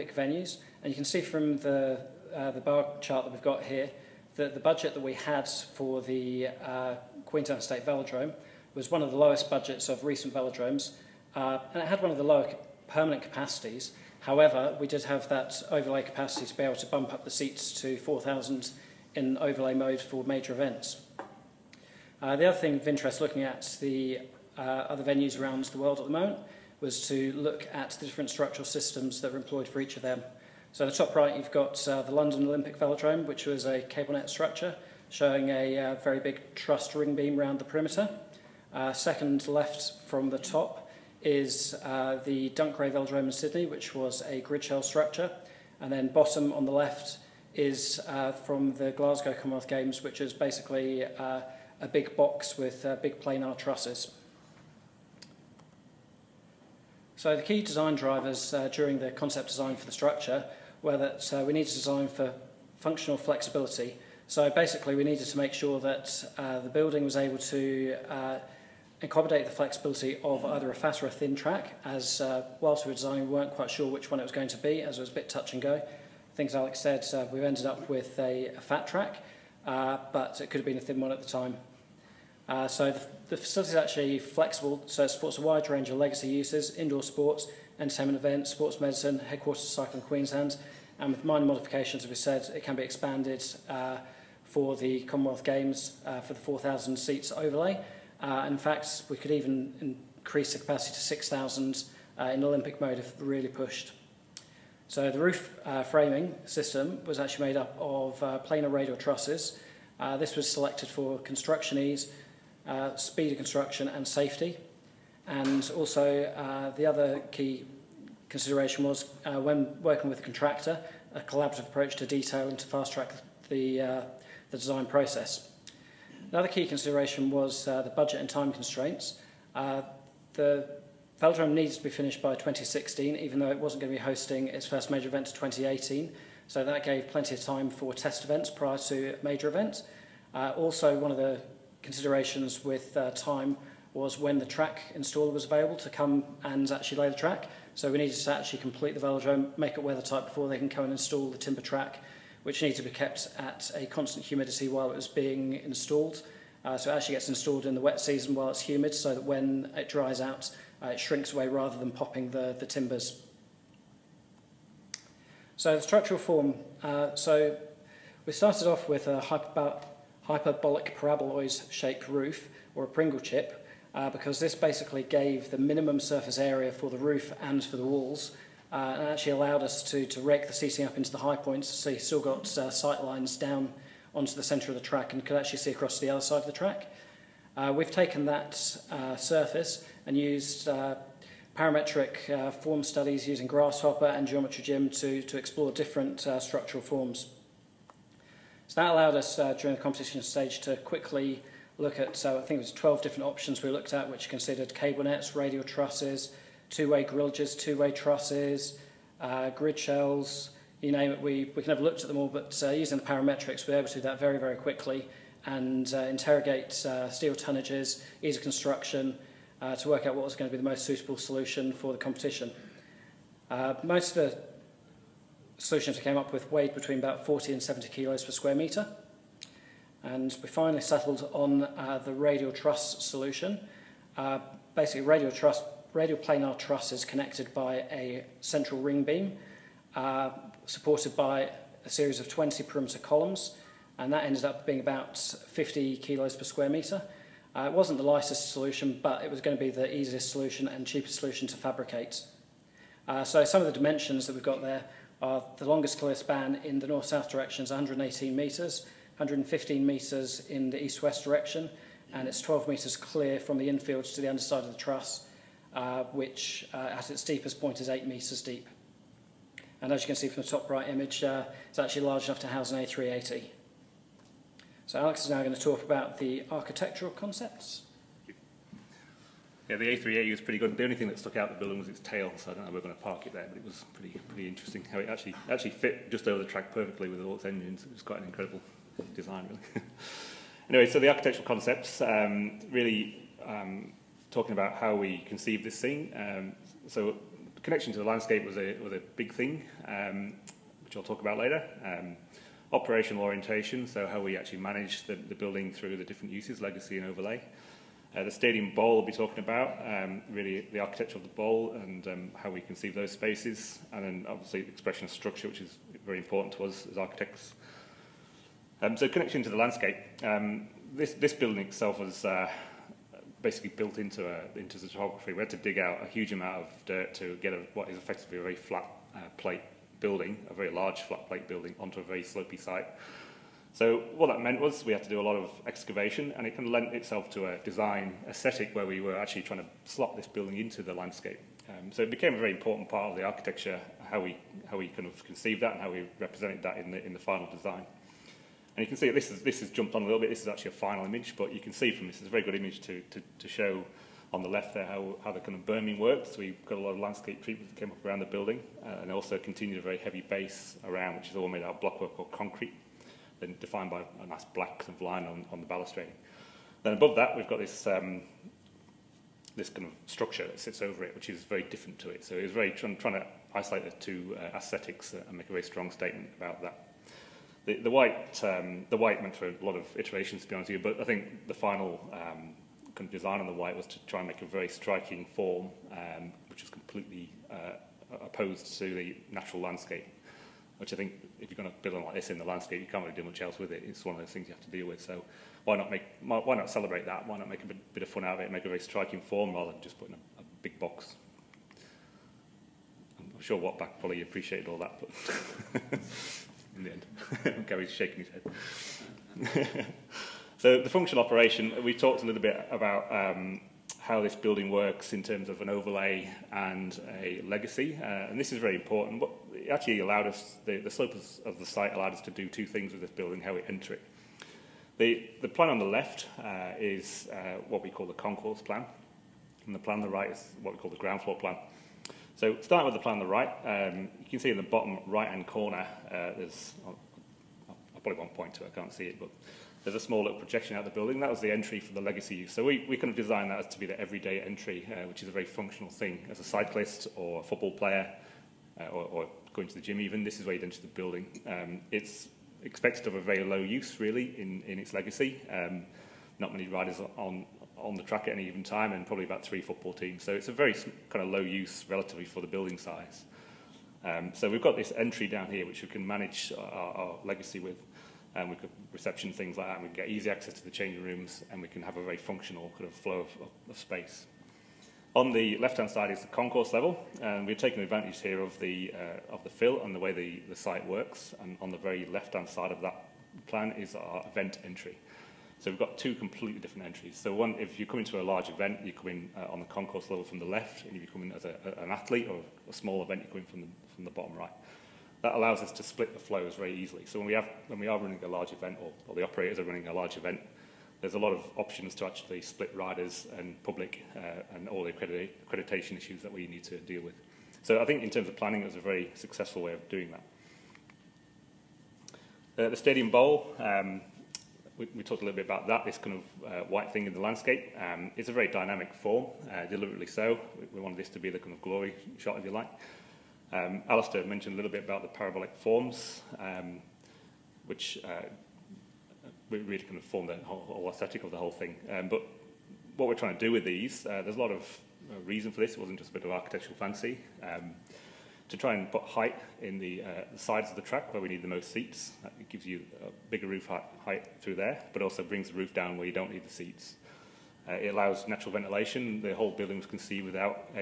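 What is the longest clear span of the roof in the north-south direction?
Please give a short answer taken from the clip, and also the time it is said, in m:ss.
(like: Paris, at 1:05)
118 metres, at 4:17.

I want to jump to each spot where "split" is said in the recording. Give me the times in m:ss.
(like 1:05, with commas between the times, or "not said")
8:15, 8:22.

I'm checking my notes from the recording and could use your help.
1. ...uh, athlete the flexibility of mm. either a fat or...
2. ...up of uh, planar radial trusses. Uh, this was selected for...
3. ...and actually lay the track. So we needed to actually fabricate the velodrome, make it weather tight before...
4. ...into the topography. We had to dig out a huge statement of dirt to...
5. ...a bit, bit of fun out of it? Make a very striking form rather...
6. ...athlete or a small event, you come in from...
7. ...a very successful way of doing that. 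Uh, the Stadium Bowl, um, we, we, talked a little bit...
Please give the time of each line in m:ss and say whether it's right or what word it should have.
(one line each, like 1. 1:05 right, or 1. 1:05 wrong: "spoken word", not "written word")
1. 1:08 wrong: "accommodate", not "athlete"
2. 1:47 right
3. 2:26 wrong: "complete", not "fabricate"
4. 5:24 wrong: "amount", not "statement"
5. 6:37 right
6. 8:11 right
7. 8:28 right.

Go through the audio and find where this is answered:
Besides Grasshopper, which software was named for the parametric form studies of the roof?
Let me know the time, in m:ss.
3:14.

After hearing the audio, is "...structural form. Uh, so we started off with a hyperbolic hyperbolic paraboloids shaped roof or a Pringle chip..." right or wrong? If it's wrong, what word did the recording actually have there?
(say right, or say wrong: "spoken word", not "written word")
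right.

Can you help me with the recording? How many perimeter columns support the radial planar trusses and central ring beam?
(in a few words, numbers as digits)
20.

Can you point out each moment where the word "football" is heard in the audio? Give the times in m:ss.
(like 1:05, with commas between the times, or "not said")
7:27, 7:39.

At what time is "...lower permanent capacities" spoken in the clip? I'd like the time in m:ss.
0:12.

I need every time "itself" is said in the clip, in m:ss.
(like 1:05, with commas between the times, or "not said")
5:21, 5:36.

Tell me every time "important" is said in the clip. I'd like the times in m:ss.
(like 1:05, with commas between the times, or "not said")
5:16, 5:42, 6:58.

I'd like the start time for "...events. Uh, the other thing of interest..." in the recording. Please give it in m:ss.
0:20.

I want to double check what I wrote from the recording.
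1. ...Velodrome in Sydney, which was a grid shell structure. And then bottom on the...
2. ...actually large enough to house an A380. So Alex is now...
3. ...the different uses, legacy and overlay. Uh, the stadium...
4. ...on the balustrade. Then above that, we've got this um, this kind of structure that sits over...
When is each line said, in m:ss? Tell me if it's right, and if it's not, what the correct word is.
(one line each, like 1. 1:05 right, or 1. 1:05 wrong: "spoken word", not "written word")
1. 0:42 right
2. 4:31 right
3. 5:05 right
4. 6:05 right.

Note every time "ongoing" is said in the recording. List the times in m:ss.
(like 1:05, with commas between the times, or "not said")
not said.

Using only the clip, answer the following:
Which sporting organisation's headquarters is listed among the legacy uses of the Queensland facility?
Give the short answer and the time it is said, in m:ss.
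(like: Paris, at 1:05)
Cycling Queensland, at 1:29.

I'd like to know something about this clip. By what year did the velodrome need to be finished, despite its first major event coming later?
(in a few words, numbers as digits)
2016.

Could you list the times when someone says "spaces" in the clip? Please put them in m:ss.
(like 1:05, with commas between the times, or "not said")
5:13, 7:53.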